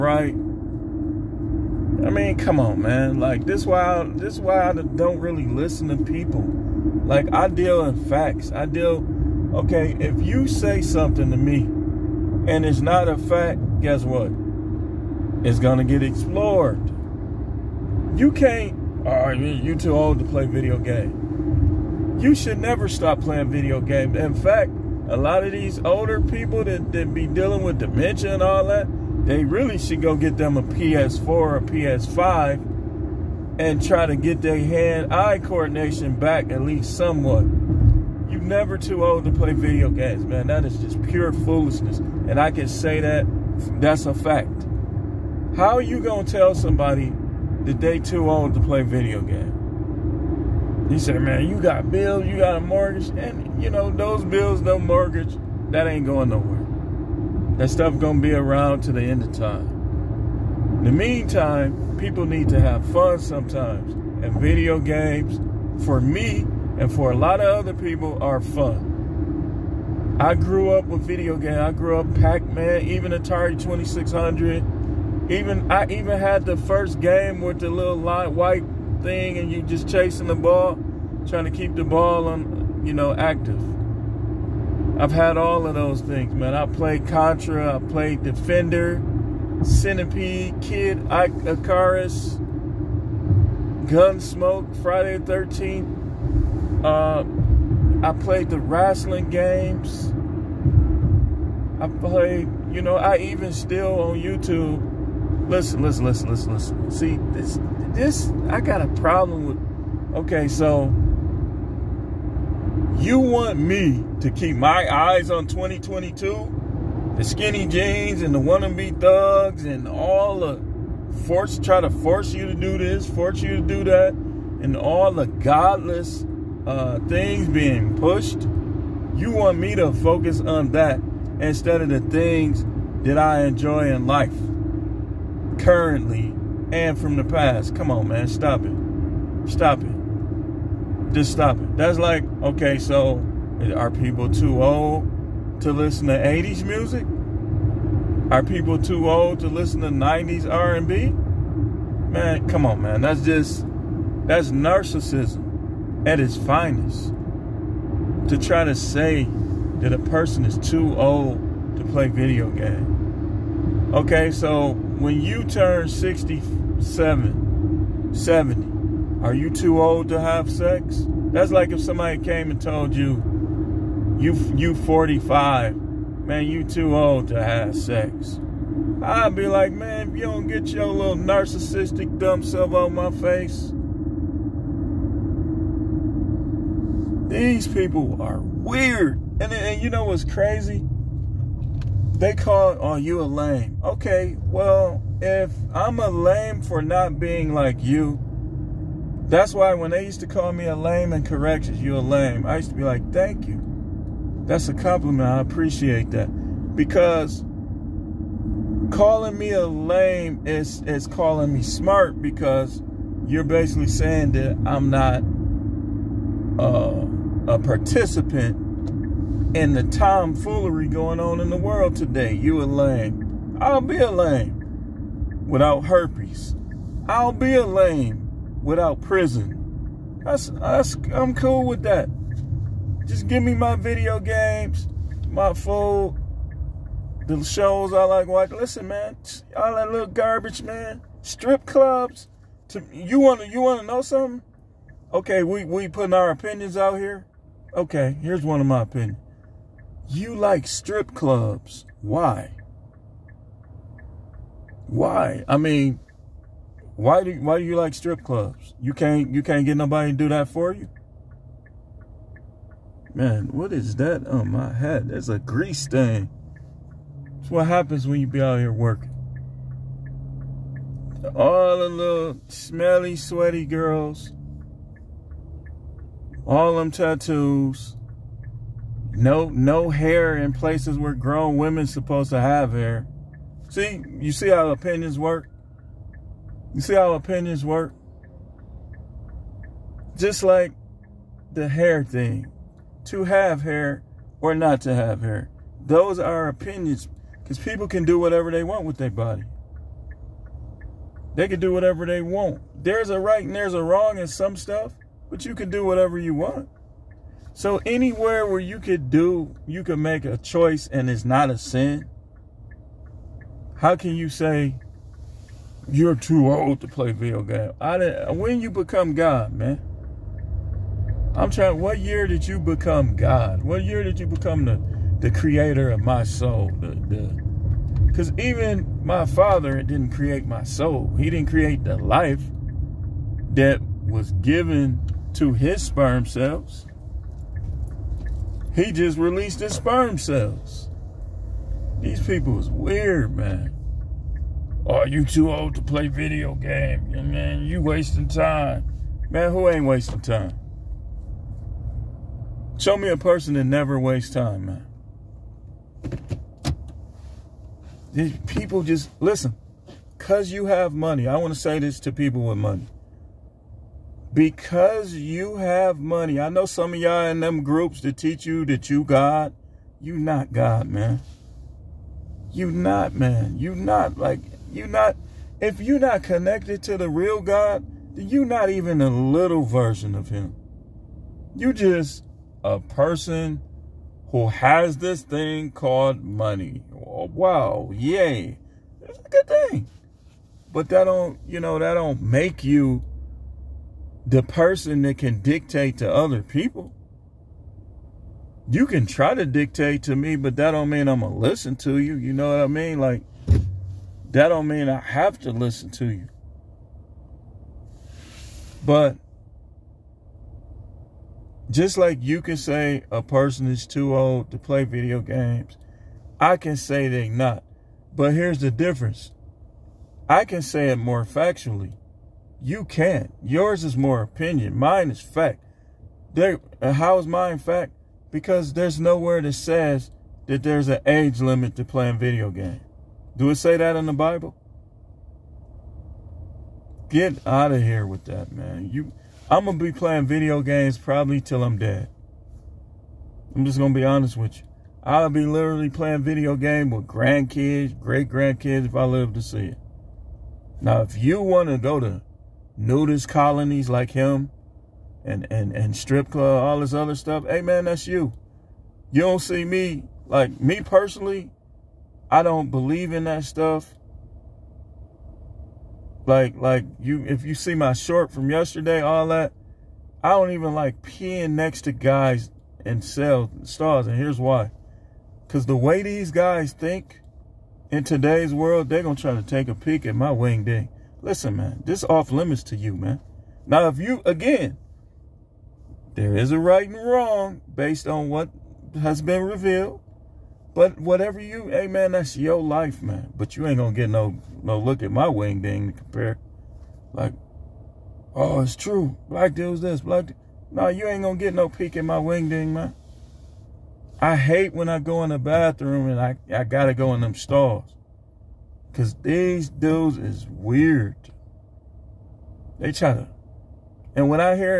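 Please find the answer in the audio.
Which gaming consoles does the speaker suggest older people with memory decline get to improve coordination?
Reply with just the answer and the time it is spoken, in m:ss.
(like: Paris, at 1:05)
PS4 or PS5, at 0:30.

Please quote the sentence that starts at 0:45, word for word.
How are you going to tell somebody that they too old to play video game?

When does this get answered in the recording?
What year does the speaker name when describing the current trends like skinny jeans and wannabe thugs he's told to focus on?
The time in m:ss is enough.
1:55.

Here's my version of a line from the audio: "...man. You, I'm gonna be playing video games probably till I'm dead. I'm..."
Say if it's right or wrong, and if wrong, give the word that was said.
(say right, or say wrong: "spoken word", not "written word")
right.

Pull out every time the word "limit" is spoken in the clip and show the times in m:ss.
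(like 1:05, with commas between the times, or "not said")
7:11, 8:02.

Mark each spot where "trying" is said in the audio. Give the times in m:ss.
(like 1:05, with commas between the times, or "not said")
1:21, 5:21.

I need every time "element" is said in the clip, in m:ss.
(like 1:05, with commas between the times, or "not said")
not said.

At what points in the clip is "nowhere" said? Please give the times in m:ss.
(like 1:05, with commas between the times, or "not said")
0:56, 7:08.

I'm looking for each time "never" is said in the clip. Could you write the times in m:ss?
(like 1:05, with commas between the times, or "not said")
0:22, 0:38, 5:53.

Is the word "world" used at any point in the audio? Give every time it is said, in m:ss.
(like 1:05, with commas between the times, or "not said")
3:41, 7:58.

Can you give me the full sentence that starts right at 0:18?
You can't, oh, you too old to play video game.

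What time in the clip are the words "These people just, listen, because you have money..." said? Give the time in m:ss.
5:58.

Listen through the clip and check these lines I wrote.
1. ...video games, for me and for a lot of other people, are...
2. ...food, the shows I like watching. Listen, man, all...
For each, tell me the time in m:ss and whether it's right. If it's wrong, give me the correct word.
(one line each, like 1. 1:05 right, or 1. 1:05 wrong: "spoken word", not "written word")
1. 1:04 right
2. 3:55 right.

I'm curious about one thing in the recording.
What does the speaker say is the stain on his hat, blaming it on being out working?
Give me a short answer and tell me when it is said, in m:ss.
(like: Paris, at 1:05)
A grease stain, at 4:25.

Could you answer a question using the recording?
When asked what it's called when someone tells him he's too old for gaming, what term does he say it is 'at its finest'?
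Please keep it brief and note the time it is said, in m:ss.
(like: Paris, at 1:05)
Narcissism, at 2:34.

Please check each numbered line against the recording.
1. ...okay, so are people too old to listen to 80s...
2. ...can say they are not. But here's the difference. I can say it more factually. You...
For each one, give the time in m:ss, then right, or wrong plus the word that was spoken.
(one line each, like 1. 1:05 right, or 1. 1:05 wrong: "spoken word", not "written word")
1. 2:22 right
2. 6:56 right.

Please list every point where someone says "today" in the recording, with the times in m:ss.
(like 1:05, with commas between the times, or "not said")
3:41, 7:58.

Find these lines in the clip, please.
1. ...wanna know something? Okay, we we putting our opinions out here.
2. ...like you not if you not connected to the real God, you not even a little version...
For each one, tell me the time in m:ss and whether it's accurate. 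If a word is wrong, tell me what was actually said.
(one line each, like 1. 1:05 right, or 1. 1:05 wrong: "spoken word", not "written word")
1. 4:03 right
2. 6:14 right.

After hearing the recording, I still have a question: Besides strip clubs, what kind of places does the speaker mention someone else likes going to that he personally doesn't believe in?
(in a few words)
Nudist colonies.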